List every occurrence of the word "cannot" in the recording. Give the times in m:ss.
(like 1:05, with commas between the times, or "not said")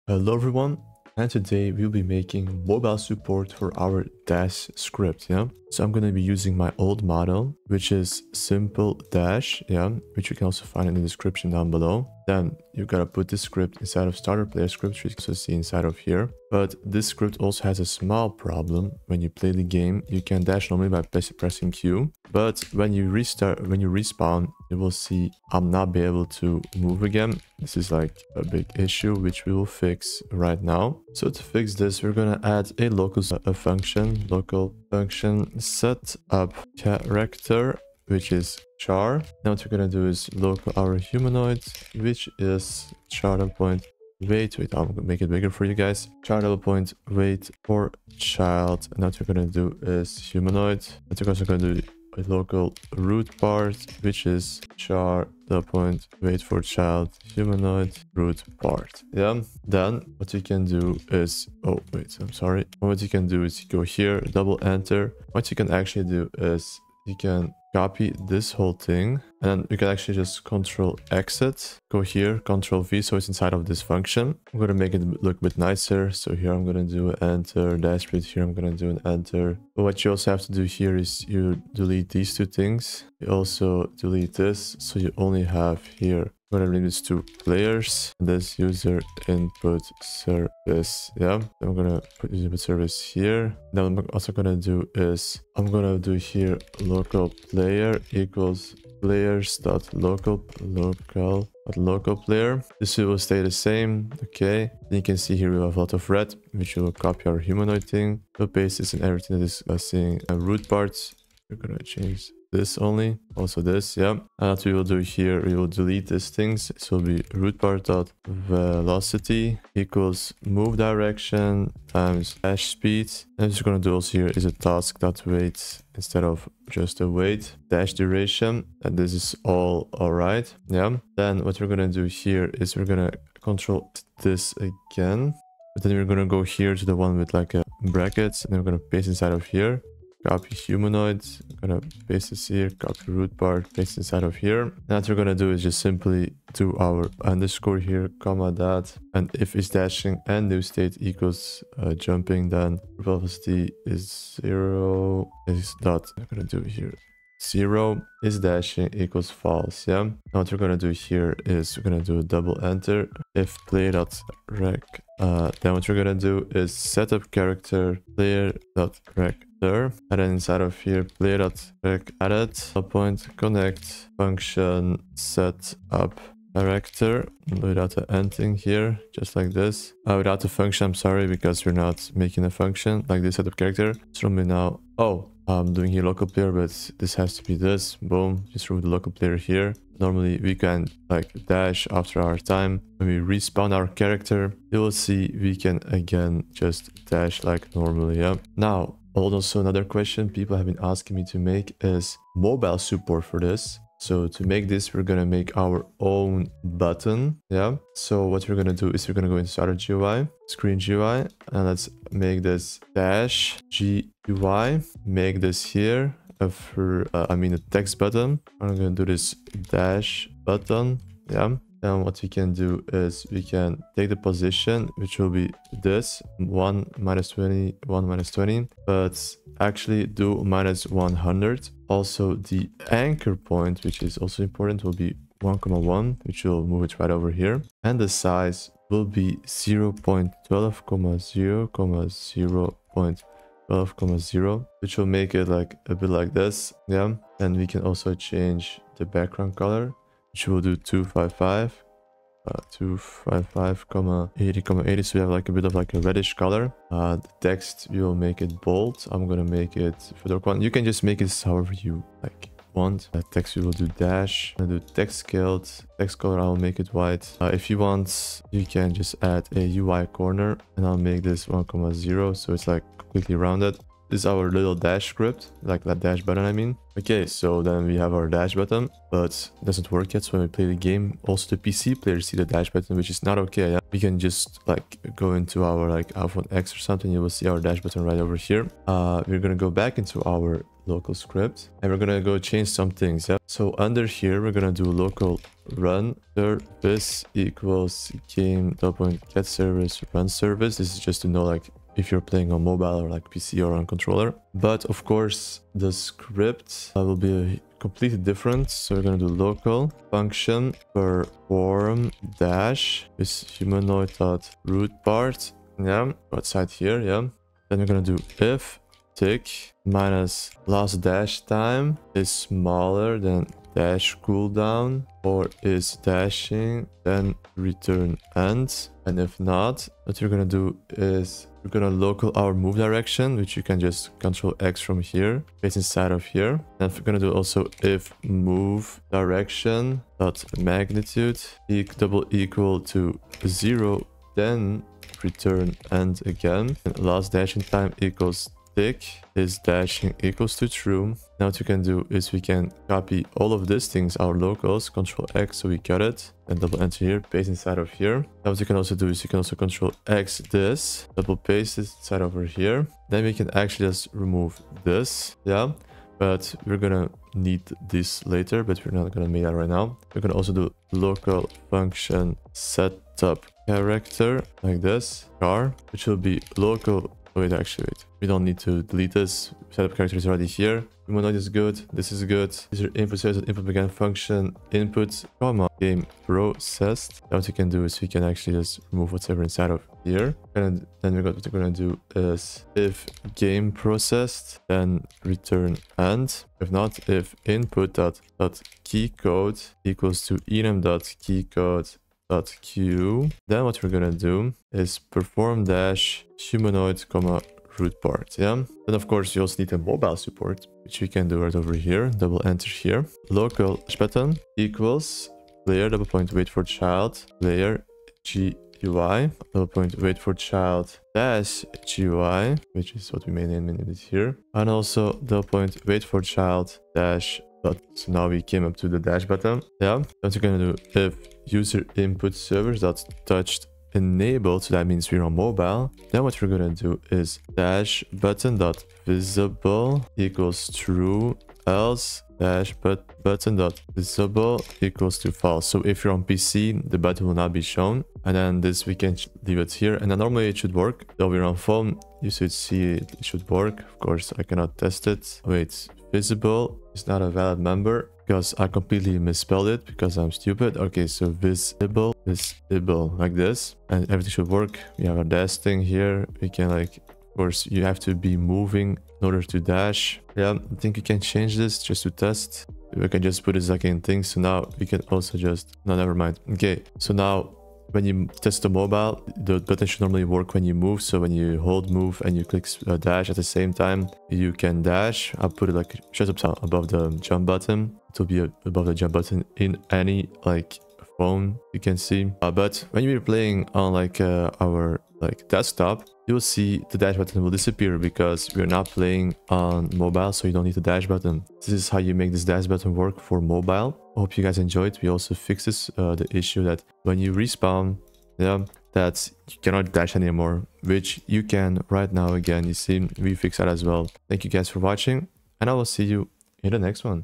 7:34, 8:29.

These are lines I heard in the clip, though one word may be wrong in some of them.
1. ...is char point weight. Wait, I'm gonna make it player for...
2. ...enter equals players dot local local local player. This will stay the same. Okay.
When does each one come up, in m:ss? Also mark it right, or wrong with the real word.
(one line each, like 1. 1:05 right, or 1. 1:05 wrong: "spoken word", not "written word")
1. 0:42 wrong: "bigger", not "player"
2. 1:37 wrong: "player", not "enter".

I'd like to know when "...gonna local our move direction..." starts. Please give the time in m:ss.
5:31.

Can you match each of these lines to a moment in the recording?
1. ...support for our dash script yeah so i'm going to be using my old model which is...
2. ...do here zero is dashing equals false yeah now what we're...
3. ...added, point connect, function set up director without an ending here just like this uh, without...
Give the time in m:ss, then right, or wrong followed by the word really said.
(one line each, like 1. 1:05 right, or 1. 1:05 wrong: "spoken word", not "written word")
1. 0:02 right
2. 2:36 right
3. 2:52 right.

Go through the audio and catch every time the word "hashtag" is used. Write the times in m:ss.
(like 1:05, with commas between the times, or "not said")
not said.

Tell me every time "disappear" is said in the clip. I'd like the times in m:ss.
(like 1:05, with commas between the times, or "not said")
8:17.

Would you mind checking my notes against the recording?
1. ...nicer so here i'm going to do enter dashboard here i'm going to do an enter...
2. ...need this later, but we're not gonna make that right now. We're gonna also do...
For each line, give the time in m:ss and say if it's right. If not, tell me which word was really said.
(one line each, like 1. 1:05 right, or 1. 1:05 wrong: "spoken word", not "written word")
1. 1:15 right
2. 6:07 right.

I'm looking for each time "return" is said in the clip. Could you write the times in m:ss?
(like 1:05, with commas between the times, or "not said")
5:27, 5:45, 6:35.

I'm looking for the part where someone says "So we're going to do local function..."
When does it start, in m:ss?
5:08.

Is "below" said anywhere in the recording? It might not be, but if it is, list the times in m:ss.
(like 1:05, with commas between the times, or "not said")
0:11.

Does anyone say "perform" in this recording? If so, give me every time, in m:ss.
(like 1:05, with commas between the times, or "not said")
5:10, 6:45.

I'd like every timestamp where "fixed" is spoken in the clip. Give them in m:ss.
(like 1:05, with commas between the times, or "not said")
8:25, 8:33.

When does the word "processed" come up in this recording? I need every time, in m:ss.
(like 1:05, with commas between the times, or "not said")
6:26, 6:33.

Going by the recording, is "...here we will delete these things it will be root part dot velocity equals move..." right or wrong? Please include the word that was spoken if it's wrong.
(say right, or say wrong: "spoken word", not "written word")
right.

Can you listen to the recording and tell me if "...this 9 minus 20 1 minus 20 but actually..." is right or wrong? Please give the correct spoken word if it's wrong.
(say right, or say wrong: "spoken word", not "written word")
wrong: "1", not "9".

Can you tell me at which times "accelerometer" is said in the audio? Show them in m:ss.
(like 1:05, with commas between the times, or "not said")
not said.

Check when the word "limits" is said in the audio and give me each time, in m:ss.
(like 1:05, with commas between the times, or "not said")
1:26.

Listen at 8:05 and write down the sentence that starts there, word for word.
I'll put it like just up above the jump button.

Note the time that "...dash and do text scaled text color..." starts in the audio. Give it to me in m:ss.
4:23.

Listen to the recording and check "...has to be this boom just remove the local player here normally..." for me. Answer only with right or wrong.
right.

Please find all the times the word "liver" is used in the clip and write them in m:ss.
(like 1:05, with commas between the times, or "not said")
not said.